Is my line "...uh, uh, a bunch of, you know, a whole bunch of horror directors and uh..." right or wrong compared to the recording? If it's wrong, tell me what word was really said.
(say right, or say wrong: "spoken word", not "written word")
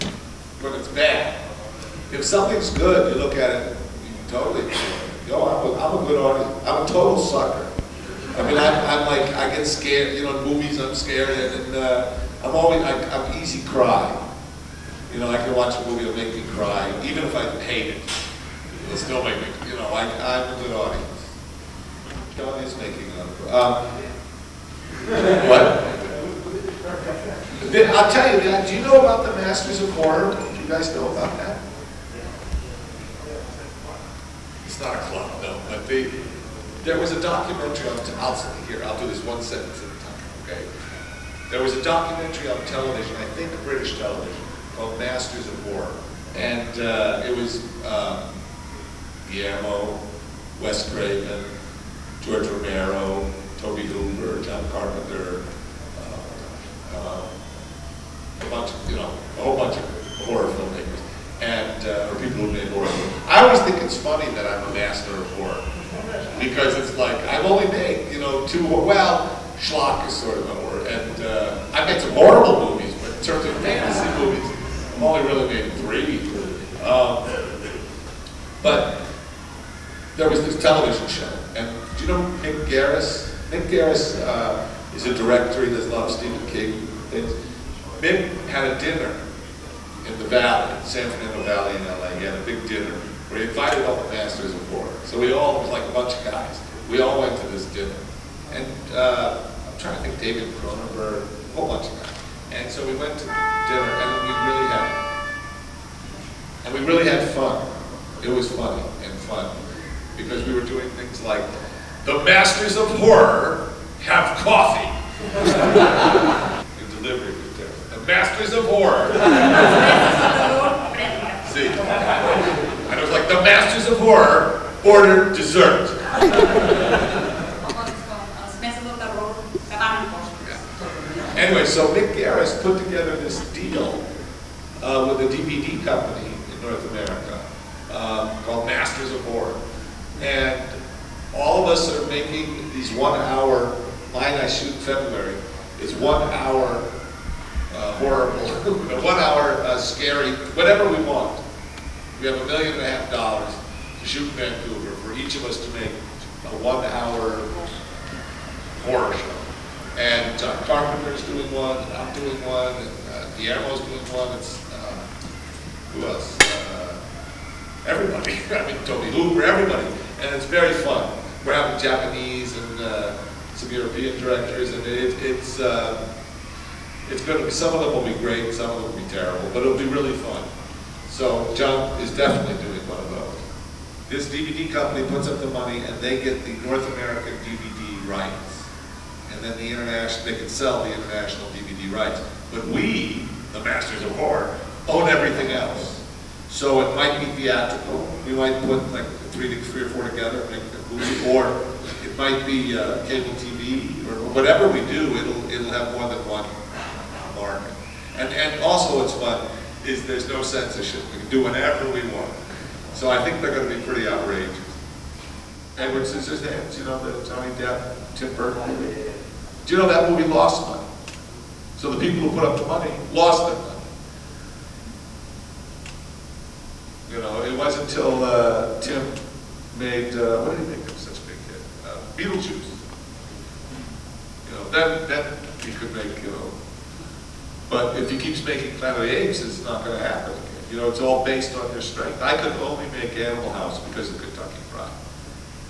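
wrong: "filmmakers", not "directors".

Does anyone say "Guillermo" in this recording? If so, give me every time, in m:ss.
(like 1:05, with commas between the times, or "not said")
0:49, 2:43.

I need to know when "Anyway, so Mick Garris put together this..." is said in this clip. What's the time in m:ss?
2:11.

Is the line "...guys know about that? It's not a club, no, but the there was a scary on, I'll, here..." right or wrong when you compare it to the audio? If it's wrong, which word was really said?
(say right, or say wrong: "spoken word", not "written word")
wrong: "documentary", not "scary".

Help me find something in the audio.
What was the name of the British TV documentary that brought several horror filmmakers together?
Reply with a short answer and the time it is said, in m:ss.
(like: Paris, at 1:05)
Masters of War, at 0:44.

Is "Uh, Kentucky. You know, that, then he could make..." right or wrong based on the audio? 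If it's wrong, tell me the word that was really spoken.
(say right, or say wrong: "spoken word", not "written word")
wrong: "Beetlejuice", not "Kentucky".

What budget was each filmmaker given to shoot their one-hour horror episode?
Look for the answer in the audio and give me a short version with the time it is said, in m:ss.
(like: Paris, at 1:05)
$1.5 million, at 2:32.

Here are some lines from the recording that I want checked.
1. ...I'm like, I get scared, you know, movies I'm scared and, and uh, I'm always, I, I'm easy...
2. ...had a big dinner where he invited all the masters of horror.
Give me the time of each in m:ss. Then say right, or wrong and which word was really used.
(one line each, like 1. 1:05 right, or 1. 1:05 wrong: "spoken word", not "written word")
1. 0:08 right
2. 1:32 right.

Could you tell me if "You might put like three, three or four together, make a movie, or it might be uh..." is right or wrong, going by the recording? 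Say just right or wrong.
right.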